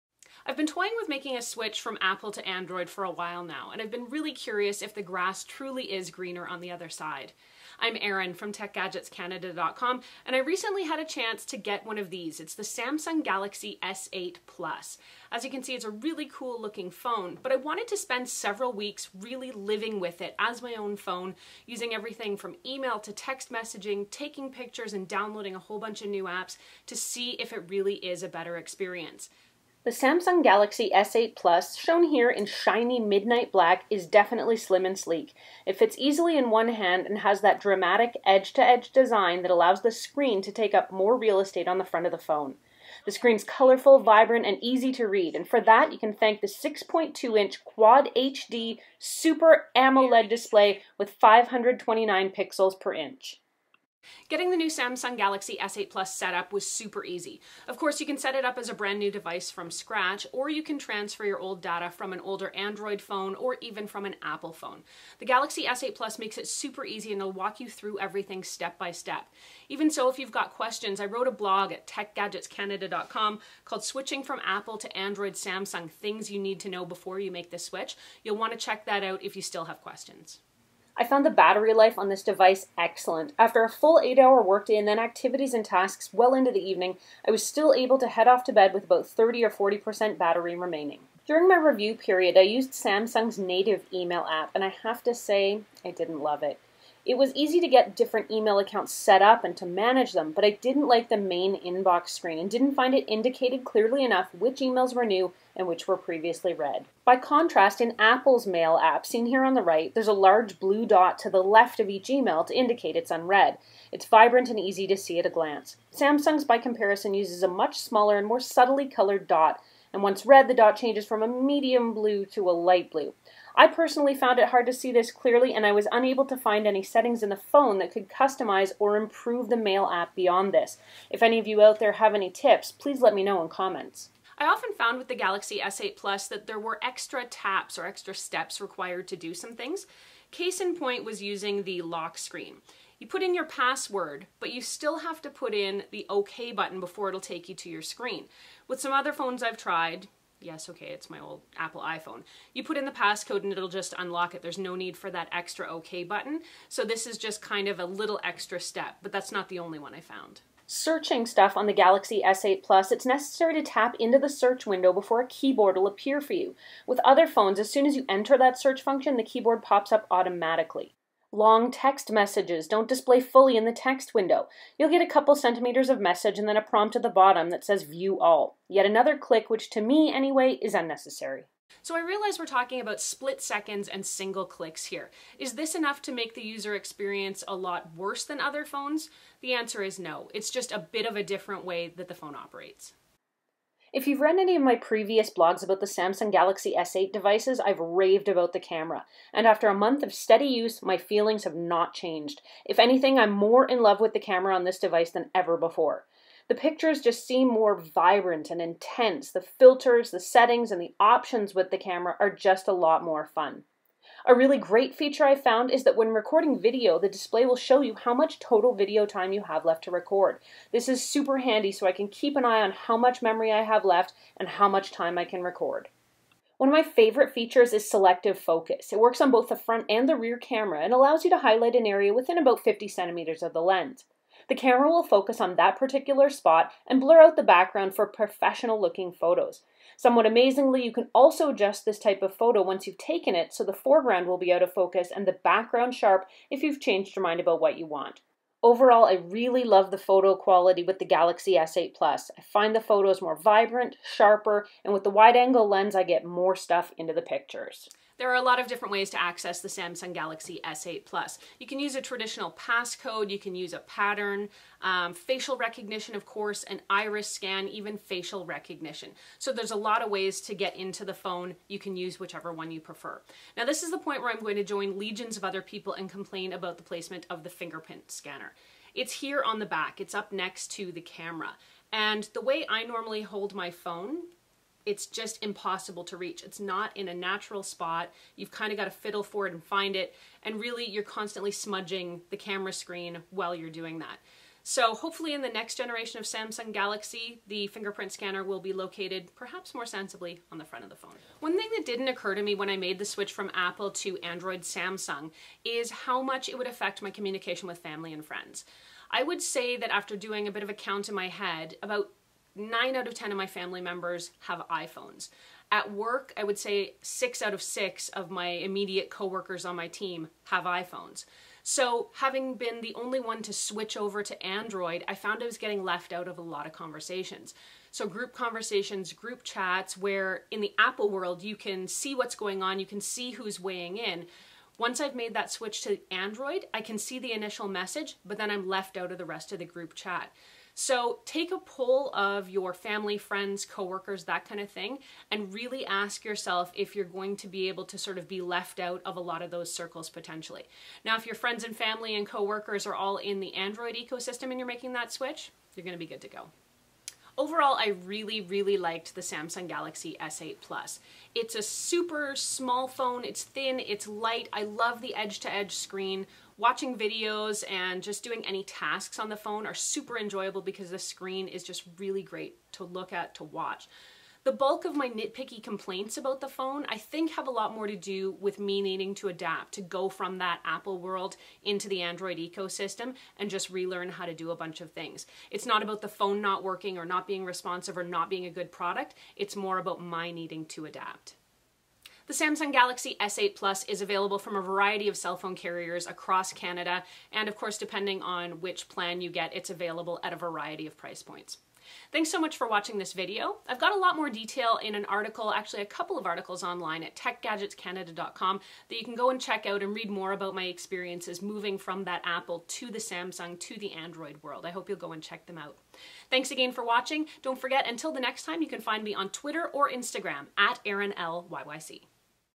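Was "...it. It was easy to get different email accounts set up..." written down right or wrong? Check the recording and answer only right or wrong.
right.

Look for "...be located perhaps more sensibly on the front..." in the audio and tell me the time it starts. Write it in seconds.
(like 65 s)
298 s.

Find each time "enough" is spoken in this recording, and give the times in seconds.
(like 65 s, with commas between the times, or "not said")
104 s, 185 s.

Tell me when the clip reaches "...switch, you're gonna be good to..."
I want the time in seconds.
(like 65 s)
355 s.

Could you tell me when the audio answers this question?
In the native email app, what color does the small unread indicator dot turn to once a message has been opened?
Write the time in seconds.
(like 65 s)
122 s.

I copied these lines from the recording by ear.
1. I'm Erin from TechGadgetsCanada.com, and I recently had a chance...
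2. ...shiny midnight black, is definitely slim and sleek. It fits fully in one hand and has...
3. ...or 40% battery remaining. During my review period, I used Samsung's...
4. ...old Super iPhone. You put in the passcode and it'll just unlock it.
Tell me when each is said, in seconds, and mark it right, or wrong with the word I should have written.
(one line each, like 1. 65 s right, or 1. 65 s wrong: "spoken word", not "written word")
1. 7 s right
2. 32 s wrong: "easily", not "fully"
3. 89 s right
4. 151 s wrong: "Apple", not "Super".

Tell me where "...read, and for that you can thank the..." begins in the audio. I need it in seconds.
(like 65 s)
45 s.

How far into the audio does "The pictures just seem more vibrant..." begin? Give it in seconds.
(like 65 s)
206 s.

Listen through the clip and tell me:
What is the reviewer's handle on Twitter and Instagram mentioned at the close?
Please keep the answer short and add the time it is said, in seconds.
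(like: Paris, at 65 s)
ErinLYYC, at 420 s.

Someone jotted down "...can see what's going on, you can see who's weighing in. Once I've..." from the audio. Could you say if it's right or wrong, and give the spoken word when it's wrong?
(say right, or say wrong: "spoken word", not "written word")
right.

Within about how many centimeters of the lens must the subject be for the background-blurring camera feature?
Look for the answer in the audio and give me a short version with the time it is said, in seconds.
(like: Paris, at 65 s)
50 centimeters, at 232 s.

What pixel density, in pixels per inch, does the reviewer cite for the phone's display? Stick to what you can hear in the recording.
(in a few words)
529.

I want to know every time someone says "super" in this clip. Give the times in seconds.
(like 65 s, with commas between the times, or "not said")
48 s, 56 s, 66 s, 221 s, 361 s, 369 s.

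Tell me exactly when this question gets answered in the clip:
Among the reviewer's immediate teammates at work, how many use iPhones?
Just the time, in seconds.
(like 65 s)
317 s.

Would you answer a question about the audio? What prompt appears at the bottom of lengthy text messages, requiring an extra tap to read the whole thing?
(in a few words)
View All.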